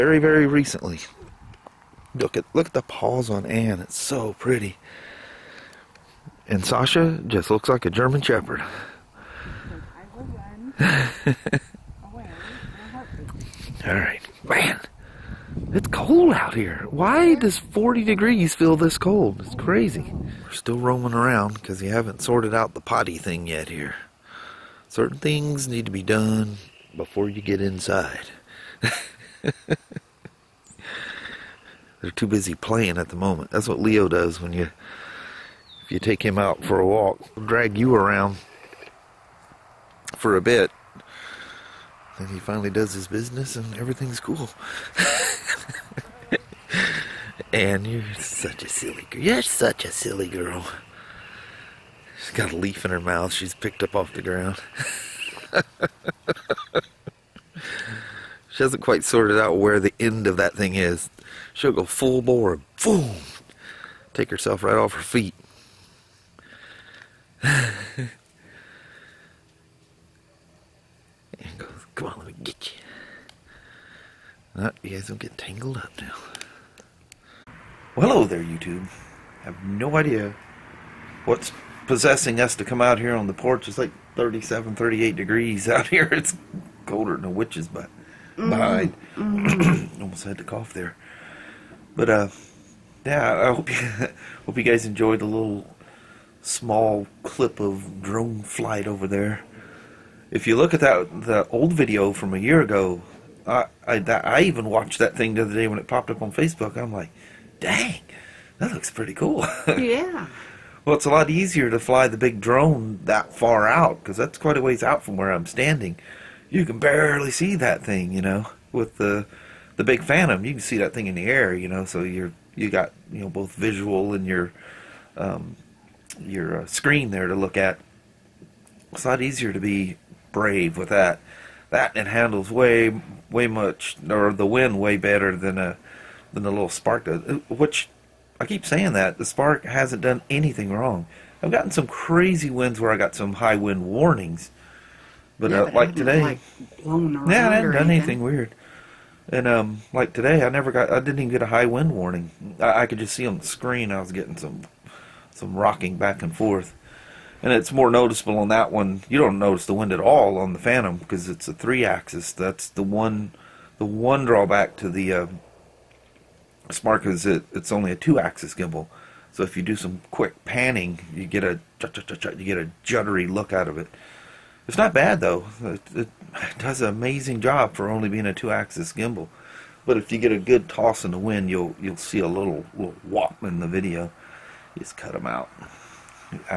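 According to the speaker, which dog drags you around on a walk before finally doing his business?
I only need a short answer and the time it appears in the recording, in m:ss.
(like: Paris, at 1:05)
Leo, at 0:33.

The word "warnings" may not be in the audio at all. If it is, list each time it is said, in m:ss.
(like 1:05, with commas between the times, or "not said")
2:23, 2:31.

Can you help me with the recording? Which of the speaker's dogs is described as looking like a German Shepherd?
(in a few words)
Sasha.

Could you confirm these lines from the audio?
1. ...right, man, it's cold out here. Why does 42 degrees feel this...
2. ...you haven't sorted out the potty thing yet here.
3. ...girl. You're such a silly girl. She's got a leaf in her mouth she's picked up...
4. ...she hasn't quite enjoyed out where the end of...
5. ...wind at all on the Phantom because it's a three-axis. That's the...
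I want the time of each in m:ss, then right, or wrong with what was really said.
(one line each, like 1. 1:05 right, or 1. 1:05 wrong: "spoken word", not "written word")
1. 0:13 wrong: "40", not "42"
2. 0:21 right
3. 0:49 right
4. 0:58 wrong: "sorted", not "enjoyed"
5. 2:39 right.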